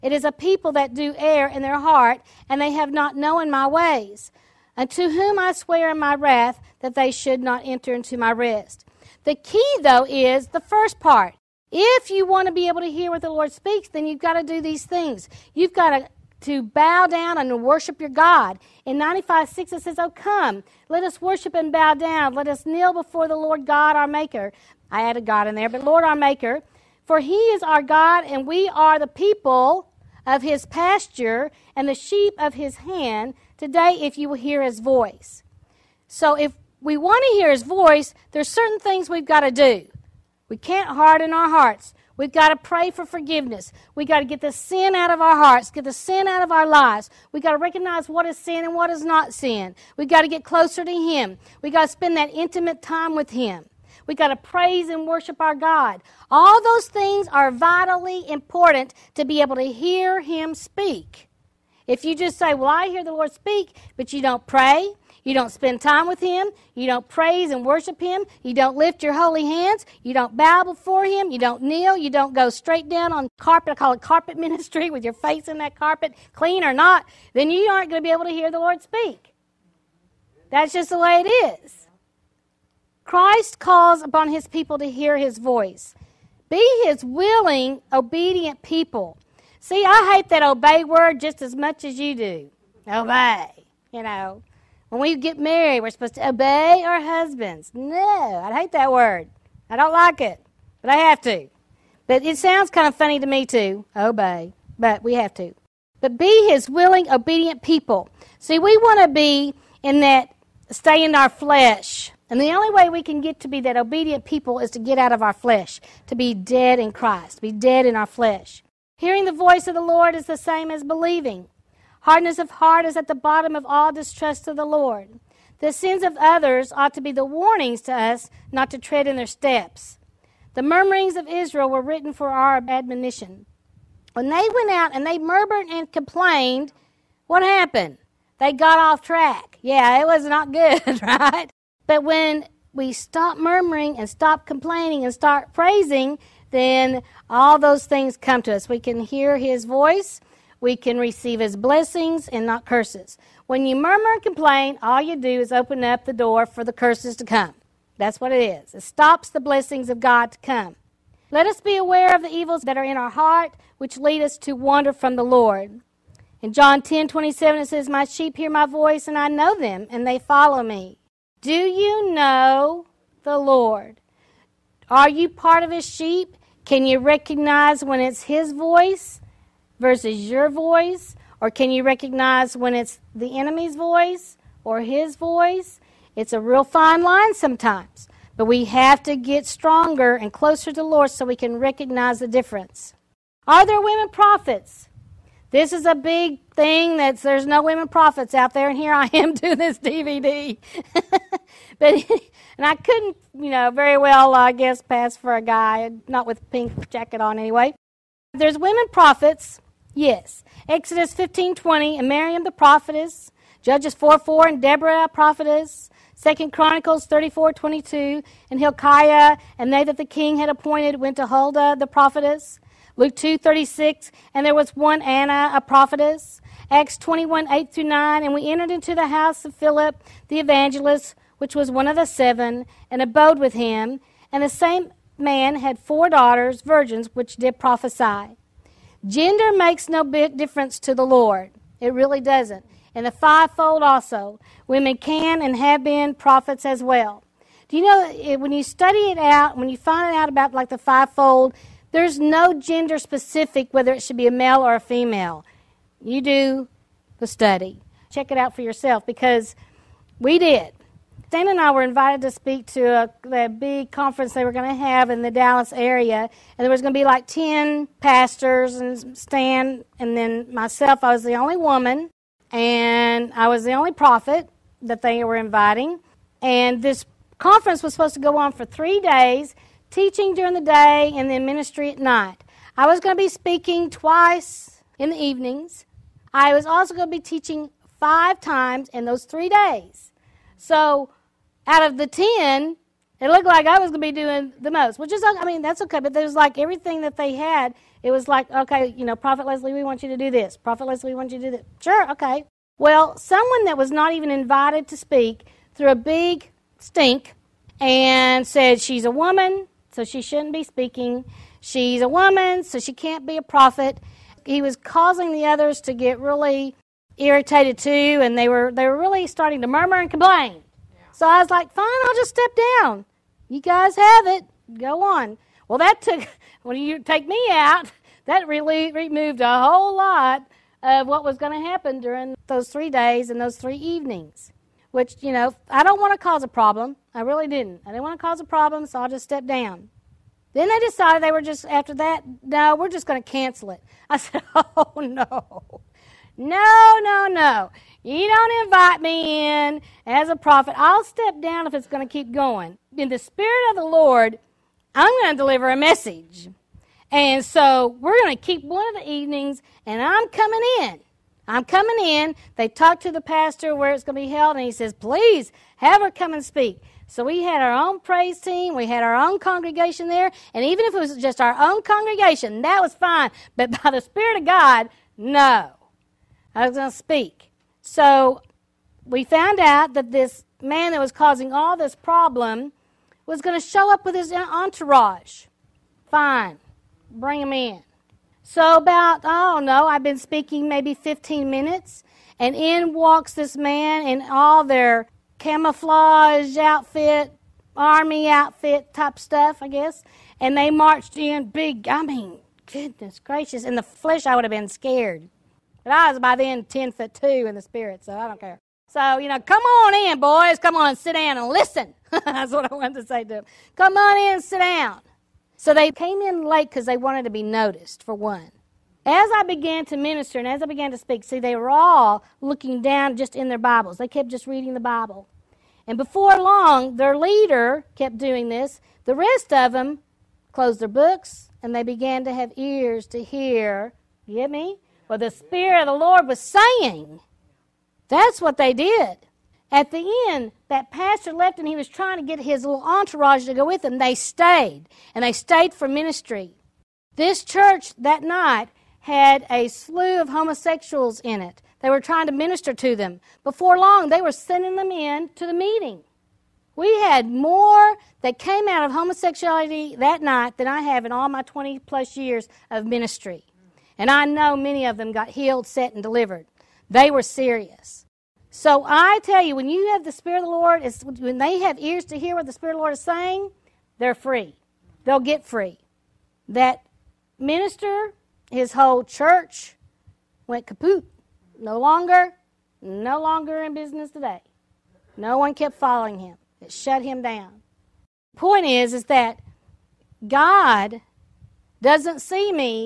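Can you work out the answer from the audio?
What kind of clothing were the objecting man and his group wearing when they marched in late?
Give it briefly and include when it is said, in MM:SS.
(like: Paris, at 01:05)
Camouflage, at 06:35.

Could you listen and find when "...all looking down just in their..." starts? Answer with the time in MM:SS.
07:01.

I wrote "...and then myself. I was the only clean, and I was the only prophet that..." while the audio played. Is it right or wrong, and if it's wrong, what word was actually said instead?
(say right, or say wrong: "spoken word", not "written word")
wrong: "woman", not "clean".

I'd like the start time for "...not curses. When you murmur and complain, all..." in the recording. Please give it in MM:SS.
02:32.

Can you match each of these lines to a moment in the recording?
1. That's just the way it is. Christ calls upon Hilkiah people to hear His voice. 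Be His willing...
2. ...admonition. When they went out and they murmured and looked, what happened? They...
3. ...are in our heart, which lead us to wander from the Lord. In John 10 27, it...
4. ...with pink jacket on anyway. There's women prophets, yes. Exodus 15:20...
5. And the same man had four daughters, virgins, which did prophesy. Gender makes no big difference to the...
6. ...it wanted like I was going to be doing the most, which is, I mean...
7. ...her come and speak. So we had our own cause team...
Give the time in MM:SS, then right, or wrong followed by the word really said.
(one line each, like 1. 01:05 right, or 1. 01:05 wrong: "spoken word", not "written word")
1. 01:20 wrong: "His", not "Hilkiah"
2. 02:12 wrong: "complained", not "looked"
3. 02:42 right
4. 03:26 right
5. 03:54 right
6. 04:53 wrong: "looked", not "wanted"
7. 06:06 wrong: "praise", not "cause".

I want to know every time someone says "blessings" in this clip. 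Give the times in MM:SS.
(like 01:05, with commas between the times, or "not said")
02:31, 02:39.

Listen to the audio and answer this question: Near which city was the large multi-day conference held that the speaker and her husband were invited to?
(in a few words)
Dallas.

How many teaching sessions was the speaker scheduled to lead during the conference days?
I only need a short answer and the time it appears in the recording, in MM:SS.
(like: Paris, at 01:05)
5, at 04:47.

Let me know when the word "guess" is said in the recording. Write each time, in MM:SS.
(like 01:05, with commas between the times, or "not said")
03:24, 06:39.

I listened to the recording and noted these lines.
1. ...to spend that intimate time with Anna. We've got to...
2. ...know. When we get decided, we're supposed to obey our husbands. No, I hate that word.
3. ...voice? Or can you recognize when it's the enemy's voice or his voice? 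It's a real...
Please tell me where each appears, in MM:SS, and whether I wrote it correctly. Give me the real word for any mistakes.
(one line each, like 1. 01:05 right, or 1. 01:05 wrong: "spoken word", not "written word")
1. 00:51 wrong: "Him", not "Anna"
2. 01:34 wrong: "married", not "decided"
3. 03:00 right.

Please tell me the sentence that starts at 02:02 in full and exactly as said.
Hardness of heart is at the bottom of all distrust of the Lord.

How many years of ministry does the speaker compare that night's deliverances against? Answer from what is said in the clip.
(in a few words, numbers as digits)
20 plus.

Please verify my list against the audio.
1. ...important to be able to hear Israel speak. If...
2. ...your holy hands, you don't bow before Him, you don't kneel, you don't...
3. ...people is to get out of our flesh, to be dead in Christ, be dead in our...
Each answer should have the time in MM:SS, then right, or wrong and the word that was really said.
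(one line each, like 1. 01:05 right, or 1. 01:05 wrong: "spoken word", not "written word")
1. 00:58 wrong: "Him", not "Israel"
2. 01:09 right
3. 01:54 right.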